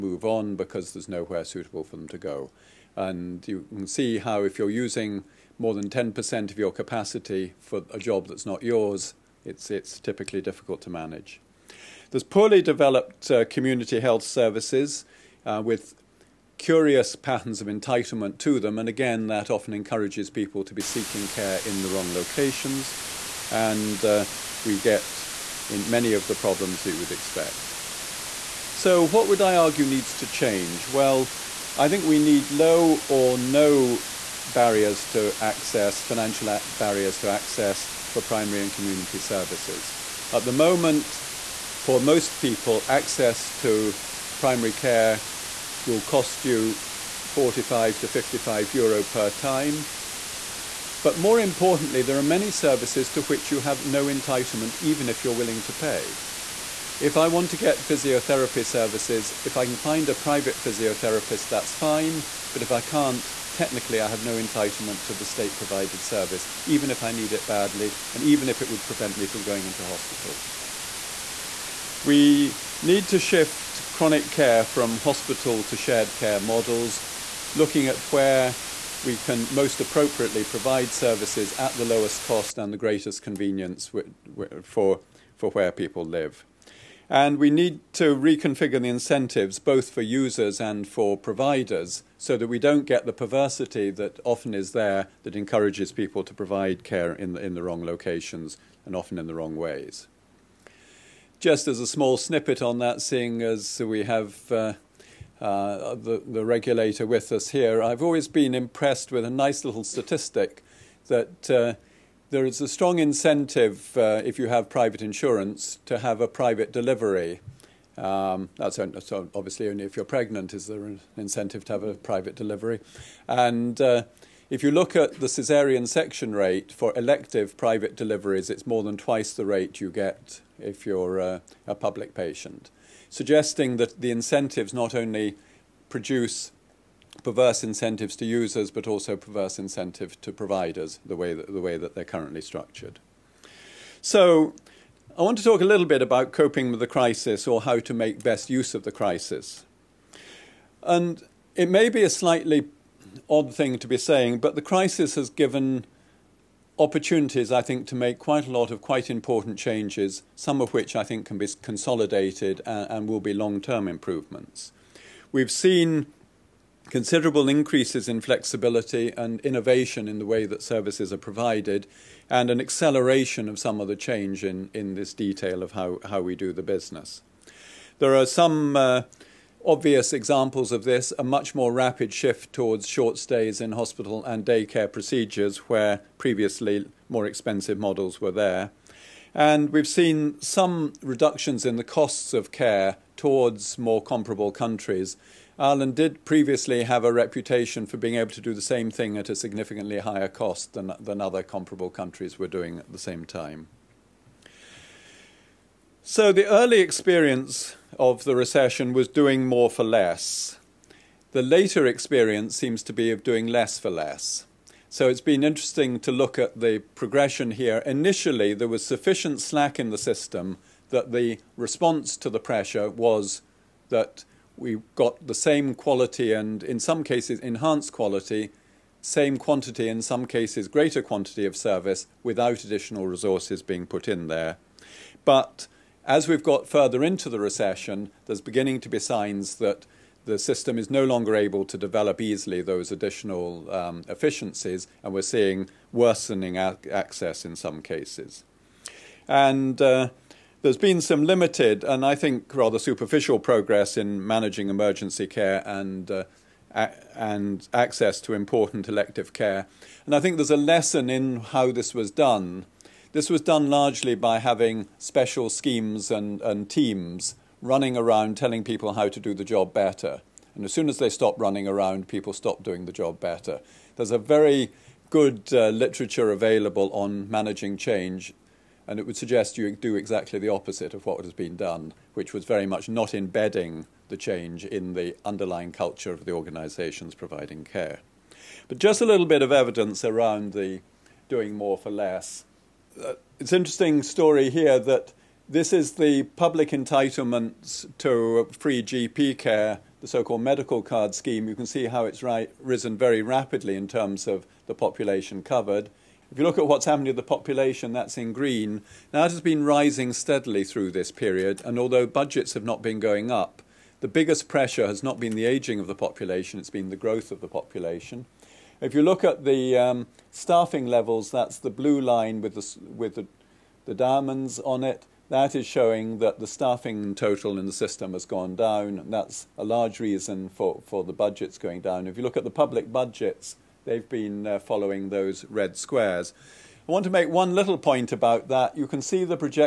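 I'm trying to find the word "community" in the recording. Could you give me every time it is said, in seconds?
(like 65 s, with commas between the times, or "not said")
13 s, 38 s.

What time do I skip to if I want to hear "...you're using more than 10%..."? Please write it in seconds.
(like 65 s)
4 s.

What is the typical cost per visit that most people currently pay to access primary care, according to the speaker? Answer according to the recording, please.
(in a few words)
45 to 55 euro.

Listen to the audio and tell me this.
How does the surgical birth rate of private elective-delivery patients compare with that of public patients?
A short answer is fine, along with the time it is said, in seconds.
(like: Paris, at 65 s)
More than twice, at 128 s.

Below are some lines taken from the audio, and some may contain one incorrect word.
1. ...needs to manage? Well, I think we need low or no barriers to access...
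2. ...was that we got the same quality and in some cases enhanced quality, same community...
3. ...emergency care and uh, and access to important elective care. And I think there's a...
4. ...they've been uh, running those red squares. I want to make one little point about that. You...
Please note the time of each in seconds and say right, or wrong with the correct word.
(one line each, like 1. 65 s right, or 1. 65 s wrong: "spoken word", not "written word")
1. 29 s wrong: "change", not "manage"
2. 222 s wrong: "quantity", not "community"
3. 254 s right
4. 333 s wrong: "following", not "running".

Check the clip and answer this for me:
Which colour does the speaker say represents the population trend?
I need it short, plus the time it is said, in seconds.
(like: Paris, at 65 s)
Green, at 308 s.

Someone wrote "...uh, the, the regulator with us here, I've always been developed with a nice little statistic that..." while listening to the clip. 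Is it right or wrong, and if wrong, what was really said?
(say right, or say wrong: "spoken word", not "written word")
wrong: "impressed", not "developed".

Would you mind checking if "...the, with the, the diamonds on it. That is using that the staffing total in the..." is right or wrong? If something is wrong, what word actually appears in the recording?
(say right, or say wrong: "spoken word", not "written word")
wrong: "showing", not "using".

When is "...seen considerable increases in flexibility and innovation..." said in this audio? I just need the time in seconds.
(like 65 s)
165 s.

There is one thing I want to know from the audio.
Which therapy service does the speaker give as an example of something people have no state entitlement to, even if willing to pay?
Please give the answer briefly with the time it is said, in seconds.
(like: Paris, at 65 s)
Physiotherapy, at 57 s.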